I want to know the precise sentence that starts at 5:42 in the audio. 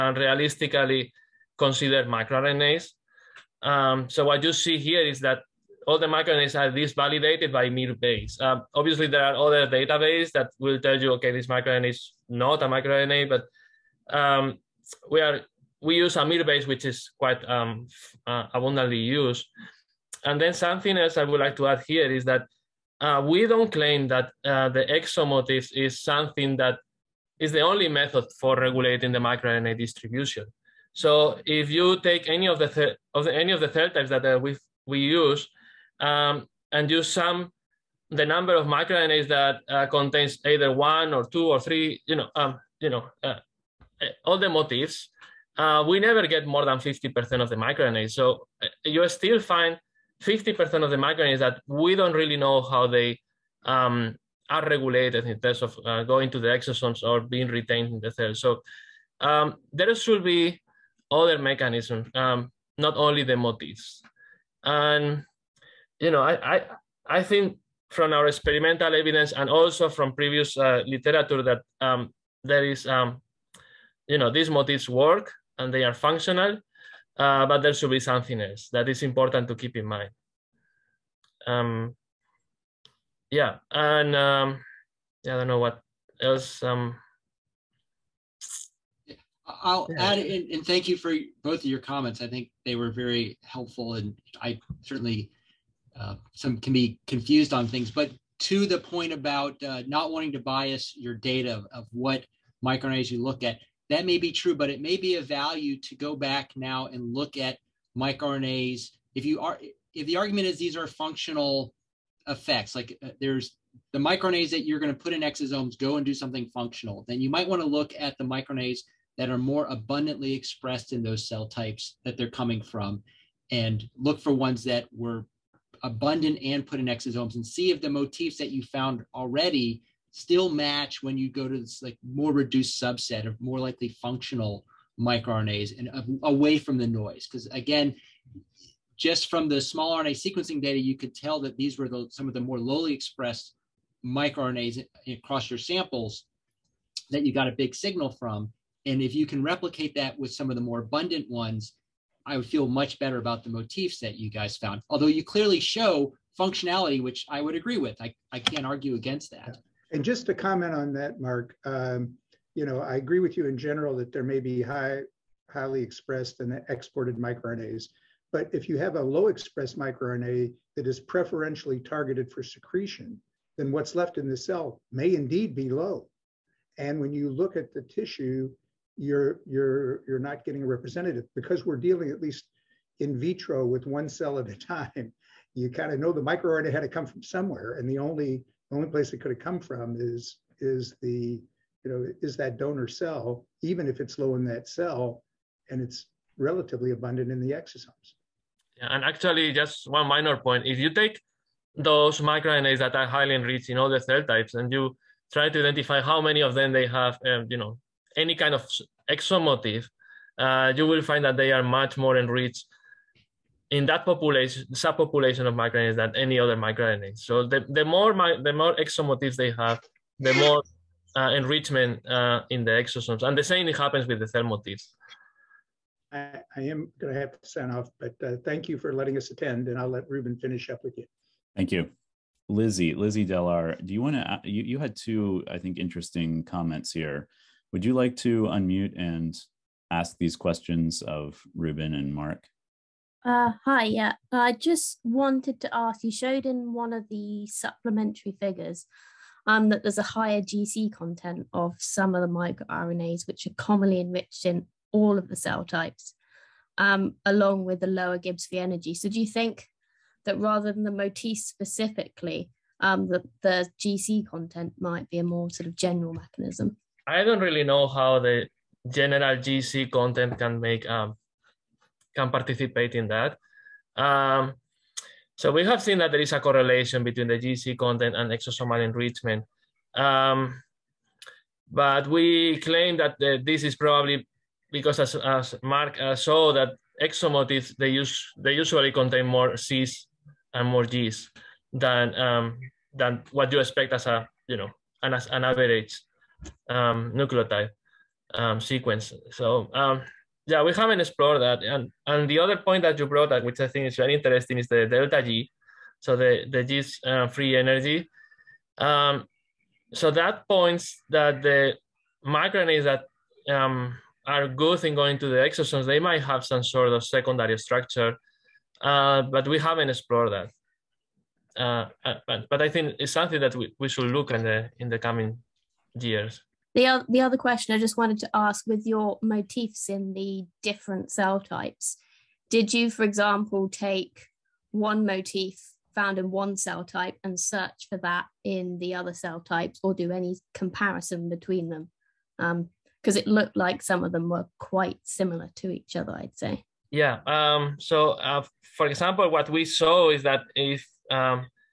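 Because um, it looked like some of them were quite similar to each other, I'd say.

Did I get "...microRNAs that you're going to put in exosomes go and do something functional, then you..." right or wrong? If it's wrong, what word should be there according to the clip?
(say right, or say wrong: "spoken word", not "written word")
right.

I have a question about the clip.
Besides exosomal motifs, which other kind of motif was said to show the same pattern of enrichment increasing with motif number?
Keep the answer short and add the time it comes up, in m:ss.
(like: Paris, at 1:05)
thermotives, at 3:44.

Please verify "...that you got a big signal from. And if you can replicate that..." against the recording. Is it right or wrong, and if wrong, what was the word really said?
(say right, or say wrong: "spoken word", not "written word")
right.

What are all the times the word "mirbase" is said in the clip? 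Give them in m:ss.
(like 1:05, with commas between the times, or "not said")
0:07, 0:16.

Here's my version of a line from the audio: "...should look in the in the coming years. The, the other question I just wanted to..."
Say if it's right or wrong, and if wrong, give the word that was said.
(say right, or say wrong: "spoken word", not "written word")
right.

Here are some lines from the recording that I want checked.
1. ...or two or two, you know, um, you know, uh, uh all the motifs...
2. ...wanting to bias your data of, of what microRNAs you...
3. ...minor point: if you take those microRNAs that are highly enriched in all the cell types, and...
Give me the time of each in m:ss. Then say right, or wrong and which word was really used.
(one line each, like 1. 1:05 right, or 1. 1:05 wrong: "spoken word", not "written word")
1. 0:41 wrong: "three", not "two"
2. 1:40 right
3. 3:20 right.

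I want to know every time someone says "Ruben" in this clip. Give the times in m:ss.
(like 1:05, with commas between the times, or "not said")
3:50, 4:01.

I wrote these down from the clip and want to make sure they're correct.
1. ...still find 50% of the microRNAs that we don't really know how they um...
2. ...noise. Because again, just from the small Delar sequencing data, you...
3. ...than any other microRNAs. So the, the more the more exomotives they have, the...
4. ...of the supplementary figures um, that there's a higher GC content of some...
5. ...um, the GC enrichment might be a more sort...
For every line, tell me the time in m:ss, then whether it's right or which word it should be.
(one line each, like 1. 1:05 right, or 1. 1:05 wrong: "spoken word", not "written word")
1. 0:49 right
2. 2:16 wrong: "RNA", not "Delar"
3. 3:35 right
4. 4:06 right
5. 4:22 wrong: "content", not "enrichment".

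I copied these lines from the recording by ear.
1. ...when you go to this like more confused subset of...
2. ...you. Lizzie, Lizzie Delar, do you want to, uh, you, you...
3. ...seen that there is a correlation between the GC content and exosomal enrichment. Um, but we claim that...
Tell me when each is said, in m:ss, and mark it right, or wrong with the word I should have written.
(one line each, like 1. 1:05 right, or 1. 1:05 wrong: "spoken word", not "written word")
1. 2:11 wrong: "reduced", not "confused"
2. 3:51 right
3. 4:35 right.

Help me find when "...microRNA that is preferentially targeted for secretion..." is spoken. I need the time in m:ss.
2:49.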